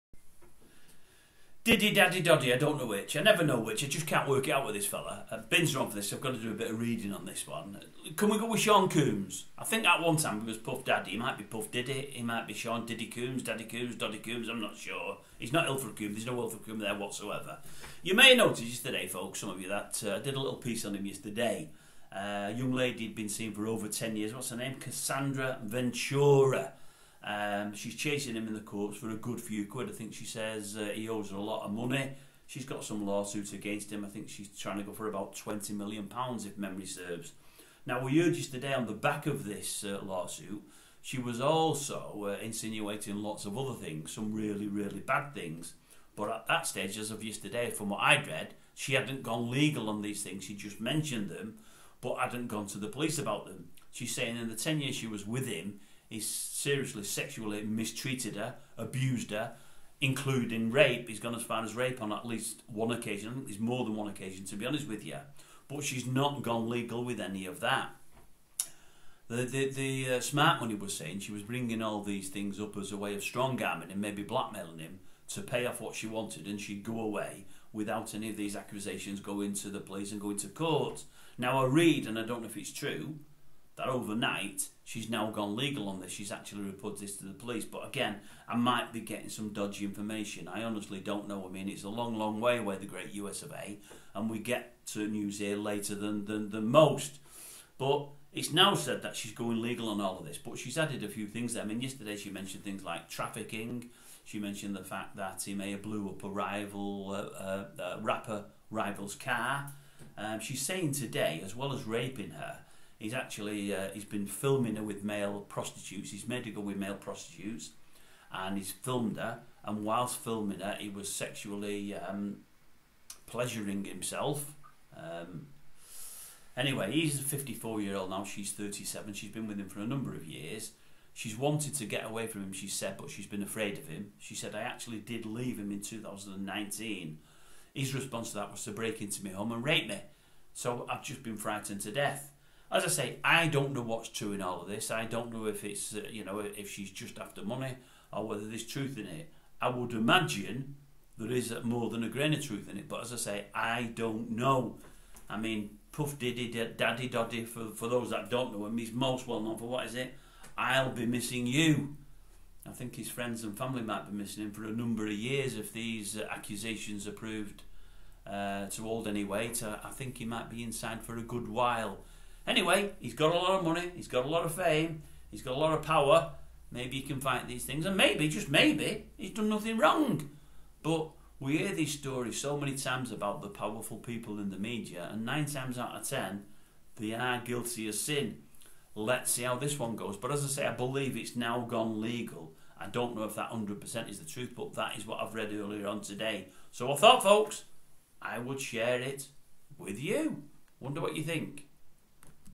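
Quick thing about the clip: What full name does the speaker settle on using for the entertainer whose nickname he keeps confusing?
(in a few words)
Sean Coombs.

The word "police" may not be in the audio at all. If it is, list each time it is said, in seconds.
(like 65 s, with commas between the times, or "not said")
52 s, 79 s, 87 s.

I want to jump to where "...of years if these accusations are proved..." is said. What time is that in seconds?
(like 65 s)
165 s.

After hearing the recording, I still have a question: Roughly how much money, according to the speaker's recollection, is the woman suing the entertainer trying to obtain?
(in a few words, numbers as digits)
20 million pounds.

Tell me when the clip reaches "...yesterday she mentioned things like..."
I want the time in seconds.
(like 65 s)
101 s.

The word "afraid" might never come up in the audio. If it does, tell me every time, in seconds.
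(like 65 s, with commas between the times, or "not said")
133 s.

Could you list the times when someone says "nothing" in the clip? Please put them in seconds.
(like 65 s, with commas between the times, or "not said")
179 s.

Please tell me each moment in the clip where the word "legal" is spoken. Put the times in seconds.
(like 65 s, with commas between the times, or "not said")
49 s, 66 s, 85 s, 99 s, 192 s.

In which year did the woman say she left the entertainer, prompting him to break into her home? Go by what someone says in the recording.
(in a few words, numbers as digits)
2019.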